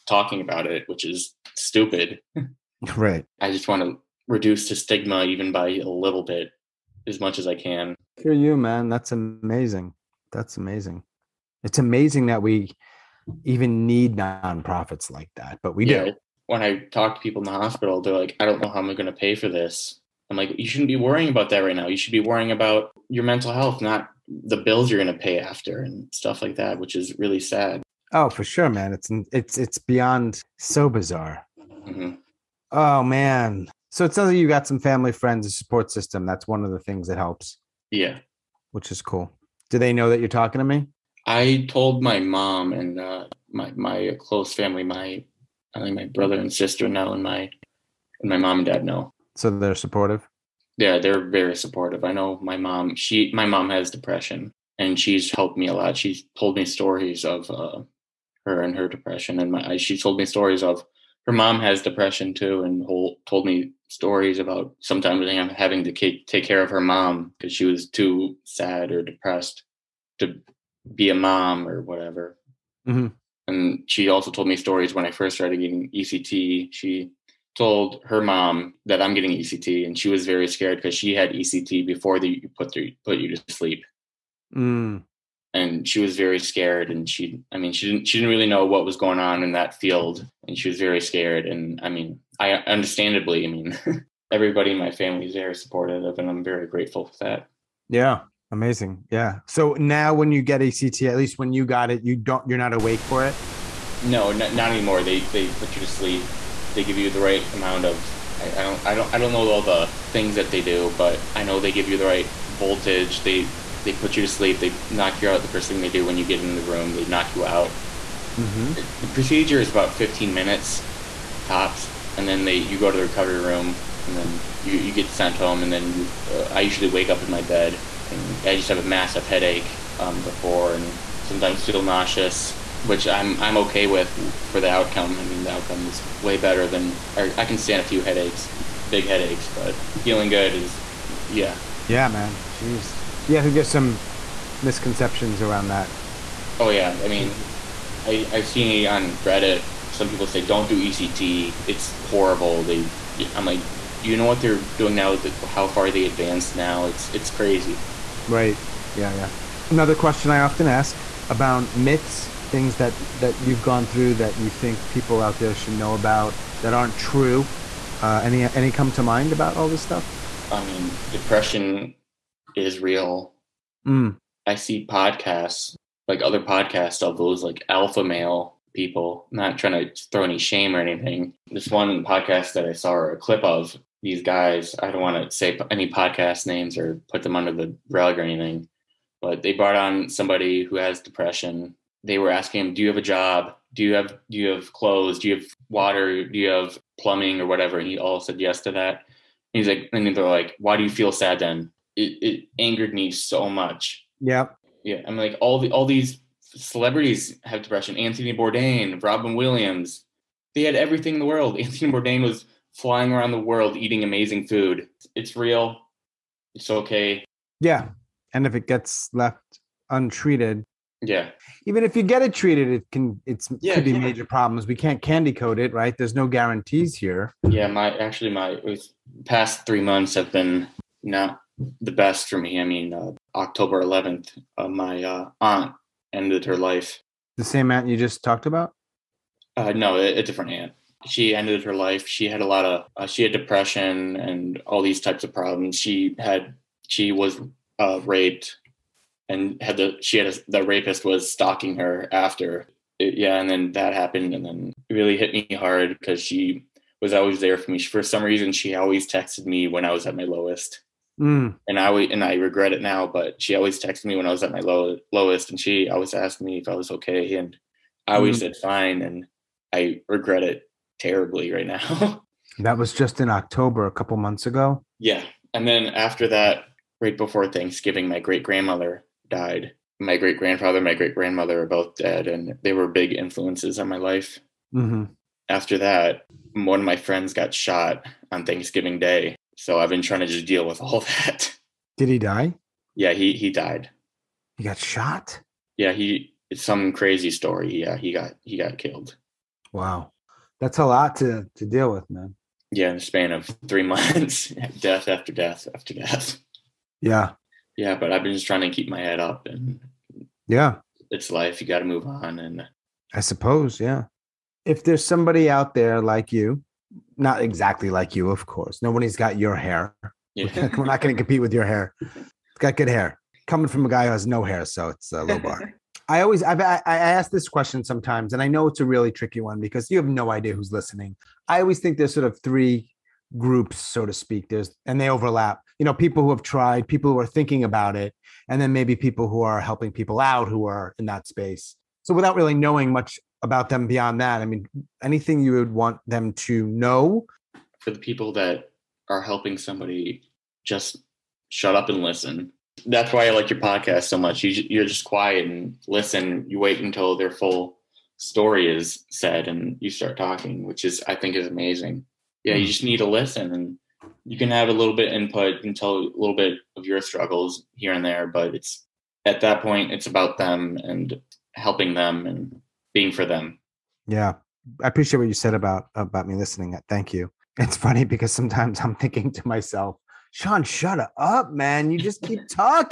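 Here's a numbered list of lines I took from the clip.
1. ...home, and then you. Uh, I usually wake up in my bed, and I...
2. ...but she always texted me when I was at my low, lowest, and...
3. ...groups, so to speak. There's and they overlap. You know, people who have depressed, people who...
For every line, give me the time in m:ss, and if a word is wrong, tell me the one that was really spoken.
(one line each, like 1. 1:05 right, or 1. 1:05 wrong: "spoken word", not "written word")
1. 2:05 right
2. 4:23 right
3. 5:33 wrong: "tried", not "depressed".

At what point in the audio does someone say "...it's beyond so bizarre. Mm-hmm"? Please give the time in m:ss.
0:29.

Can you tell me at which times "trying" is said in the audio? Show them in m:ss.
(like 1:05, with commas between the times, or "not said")
2:59, 4:50, 5:08.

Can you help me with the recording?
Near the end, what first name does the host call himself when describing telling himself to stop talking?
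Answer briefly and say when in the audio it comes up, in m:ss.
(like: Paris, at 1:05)
Sean, at 6:20.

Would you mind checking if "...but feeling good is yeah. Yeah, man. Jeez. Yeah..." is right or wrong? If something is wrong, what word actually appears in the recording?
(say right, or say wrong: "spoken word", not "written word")
right.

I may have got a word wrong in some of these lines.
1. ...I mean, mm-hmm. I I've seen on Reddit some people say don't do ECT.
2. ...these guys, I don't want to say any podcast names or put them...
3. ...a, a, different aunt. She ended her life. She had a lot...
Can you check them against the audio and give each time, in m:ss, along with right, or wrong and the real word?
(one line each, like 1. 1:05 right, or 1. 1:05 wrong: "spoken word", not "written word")
1. 2:27 right
2. 3:04 right
3. 3:59 right.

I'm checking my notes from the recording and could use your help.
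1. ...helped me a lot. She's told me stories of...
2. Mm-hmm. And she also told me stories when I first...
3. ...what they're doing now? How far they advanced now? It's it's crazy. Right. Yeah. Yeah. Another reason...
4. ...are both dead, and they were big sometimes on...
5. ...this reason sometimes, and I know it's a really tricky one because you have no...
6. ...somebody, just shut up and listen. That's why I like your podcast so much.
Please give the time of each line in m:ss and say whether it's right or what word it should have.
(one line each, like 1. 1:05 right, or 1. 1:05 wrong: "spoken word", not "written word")
1. 0:55 right
2. 1:12 right
3. 2:34 wrong: "question", not "reason"
4. 4:41 wrong: "influences", not "sometimes"
5. 5:27 wrong: "question", not "reason"
6. 5:49 right.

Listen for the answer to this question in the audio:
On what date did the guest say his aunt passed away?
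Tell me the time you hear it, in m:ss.
3:53.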